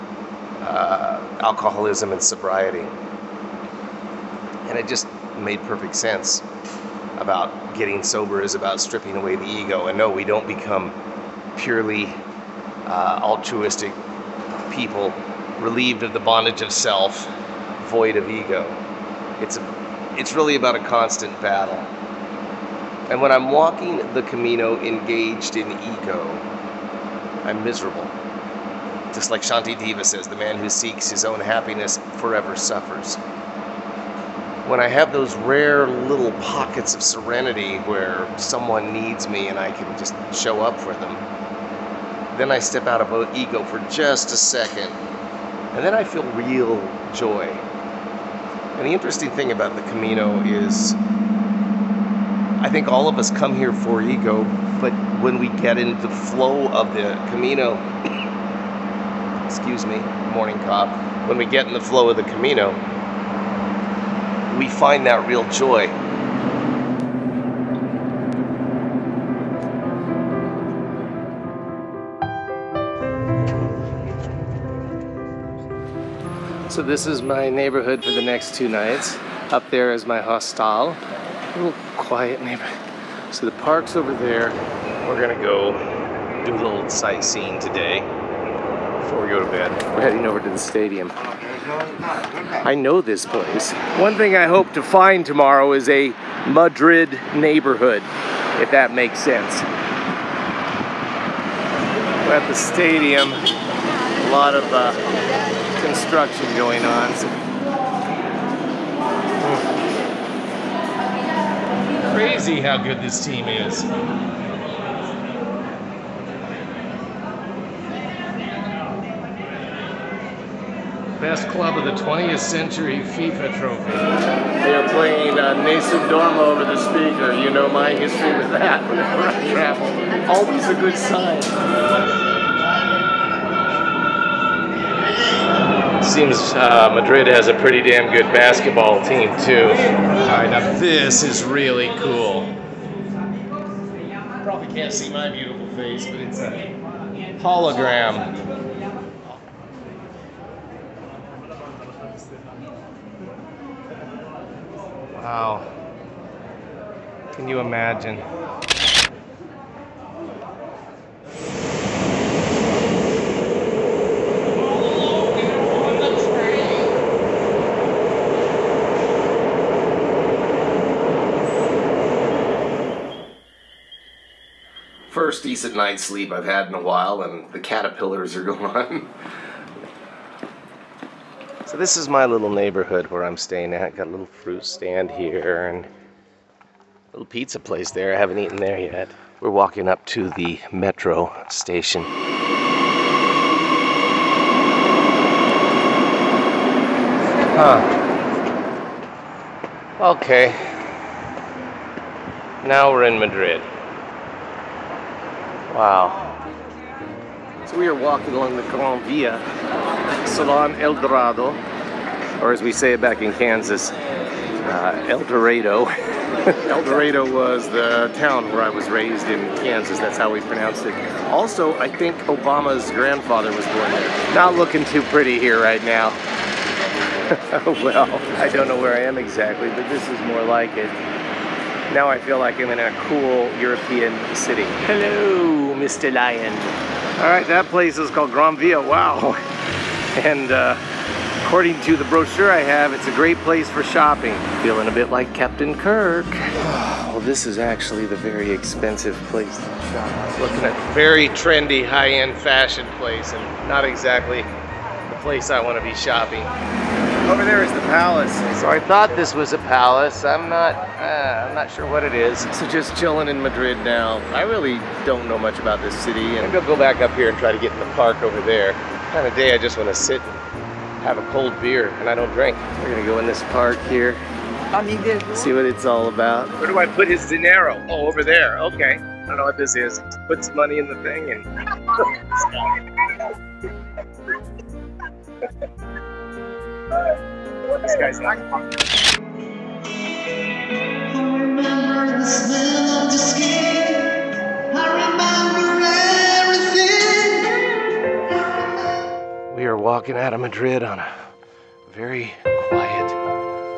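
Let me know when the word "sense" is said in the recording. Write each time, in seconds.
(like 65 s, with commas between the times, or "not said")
5 s, 99 s.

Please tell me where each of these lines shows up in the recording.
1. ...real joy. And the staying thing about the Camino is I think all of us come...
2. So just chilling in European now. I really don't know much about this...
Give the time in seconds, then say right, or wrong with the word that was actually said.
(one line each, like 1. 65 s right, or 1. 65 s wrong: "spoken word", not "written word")
1. 46 s wrong: "interesting", not "staying"
2. 262 s wrong: "Madrid", not "European".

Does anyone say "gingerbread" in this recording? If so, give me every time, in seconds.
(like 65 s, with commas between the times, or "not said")
not said.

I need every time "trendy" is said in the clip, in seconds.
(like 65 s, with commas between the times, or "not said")
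251 s.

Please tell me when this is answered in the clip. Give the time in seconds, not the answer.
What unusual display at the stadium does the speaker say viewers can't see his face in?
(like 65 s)
147 s.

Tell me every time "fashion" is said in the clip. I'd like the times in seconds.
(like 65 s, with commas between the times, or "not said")
252 s.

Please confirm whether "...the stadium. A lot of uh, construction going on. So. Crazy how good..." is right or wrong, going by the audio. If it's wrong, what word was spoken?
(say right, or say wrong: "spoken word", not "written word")
right.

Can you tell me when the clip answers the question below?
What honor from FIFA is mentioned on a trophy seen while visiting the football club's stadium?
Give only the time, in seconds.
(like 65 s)
121 s.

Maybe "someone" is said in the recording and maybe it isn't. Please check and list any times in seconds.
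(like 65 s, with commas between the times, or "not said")
38 s.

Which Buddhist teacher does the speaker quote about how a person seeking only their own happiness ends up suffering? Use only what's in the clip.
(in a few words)
Shantideva.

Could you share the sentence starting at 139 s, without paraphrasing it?
All right, now this is really cool.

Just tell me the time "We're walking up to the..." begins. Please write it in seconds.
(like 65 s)
189 s.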